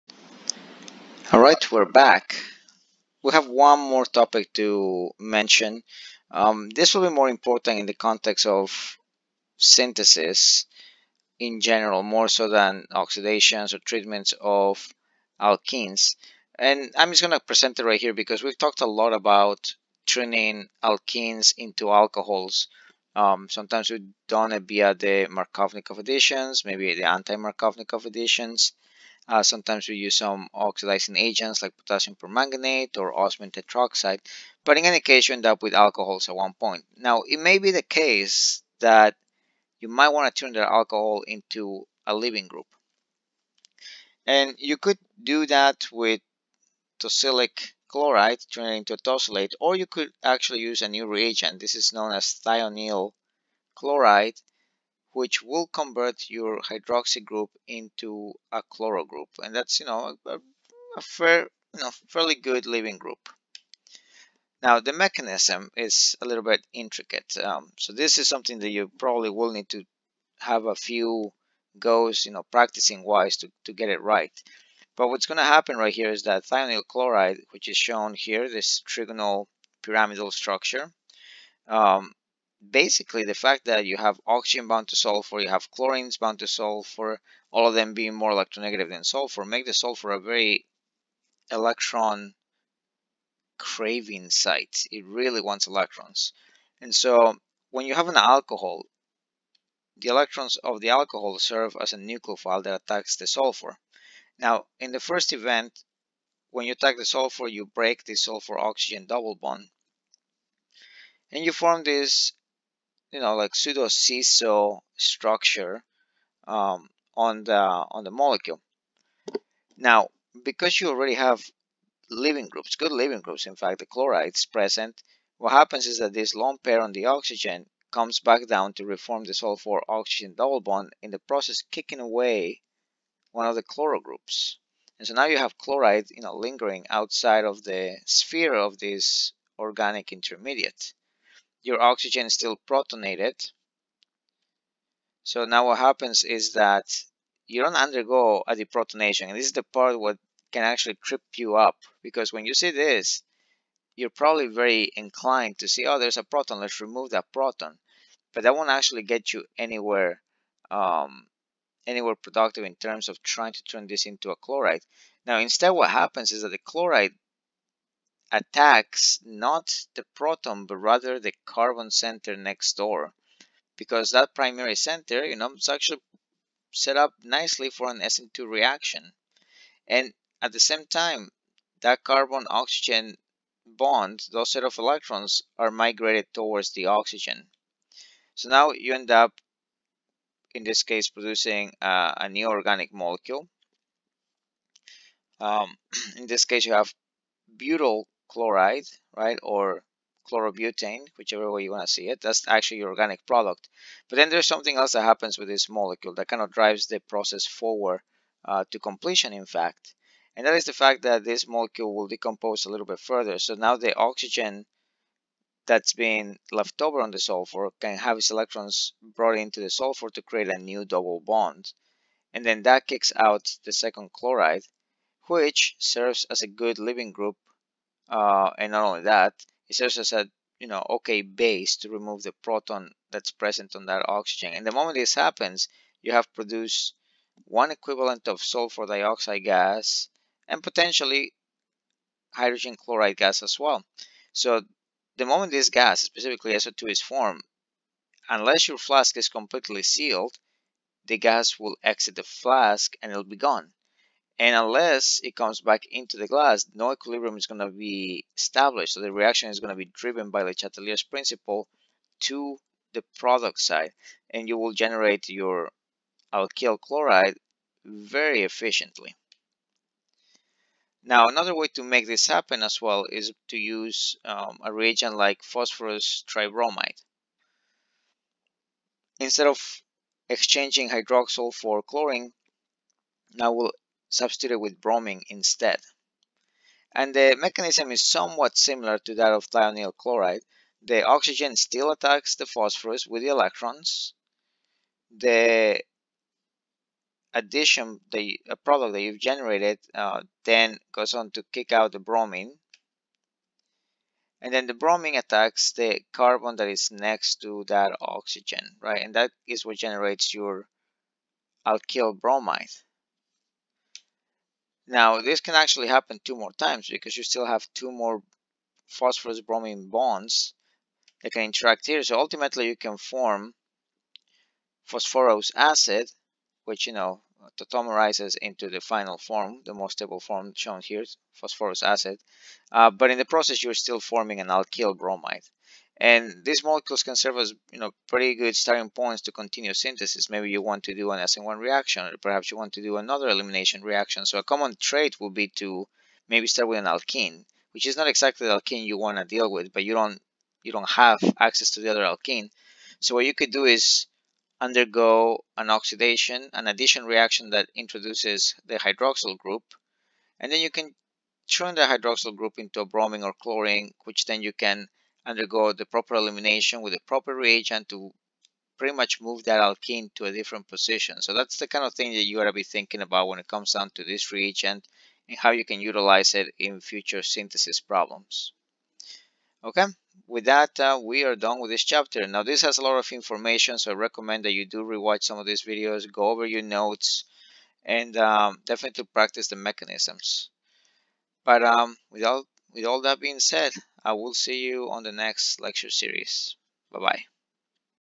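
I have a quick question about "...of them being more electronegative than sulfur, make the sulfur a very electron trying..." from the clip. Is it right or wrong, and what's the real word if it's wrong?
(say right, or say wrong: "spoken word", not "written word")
wrong: "craving", not "trying".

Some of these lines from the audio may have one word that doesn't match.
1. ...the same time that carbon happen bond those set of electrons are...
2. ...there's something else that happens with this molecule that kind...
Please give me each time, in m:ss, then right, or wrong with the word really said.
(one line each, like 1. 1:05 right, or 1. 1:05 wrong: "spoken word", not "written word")
1. 3:00 wrong: "oxygen", not "happen"
2. 3:24 right.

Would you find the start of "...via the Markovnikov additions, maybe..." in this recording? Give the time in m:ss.
0:24.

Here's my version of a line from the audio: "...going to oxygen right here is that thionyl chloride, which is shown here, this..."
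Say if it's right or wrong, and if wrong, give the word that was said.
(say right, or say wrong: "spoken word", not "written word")
wrong: "happen", not "oxygen".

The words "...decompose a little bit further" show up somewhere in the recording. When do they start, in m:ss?
3:32.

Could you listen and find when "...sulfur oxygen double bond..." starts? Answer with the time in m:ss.
2:09.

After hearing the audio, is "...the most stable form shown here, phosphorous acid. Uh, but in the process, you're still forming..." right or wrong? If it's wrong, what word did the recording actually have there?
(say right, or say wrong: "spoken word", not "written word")
right.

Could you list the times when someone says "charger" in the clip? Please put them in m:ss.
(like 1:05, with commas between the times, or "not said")
not said.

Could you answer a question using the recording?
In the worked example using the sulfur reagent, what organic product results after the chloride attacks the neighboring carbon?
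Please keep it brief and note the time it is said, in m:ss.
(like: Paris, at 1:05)
butyl chloride, at 3:17.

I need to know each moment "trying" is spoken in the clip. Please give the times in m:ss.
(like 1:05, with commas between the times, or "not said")
2:43.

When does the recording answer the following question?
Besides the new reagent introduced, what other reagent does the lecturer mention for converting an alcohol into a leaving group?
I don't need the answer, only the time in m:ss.
0:46.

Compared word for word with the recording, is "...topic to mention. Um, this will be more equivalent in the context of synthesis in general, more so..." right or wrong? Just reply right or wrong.
wrong.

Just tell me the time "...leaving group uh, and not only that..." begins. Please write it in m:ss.
3:46.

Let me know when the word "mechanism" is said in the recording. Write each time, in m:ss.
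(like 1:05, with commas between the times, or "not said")
1:04, 4:47, 6:29.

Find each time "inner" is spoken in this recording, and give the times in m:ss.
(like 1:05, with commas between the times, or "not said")
not said.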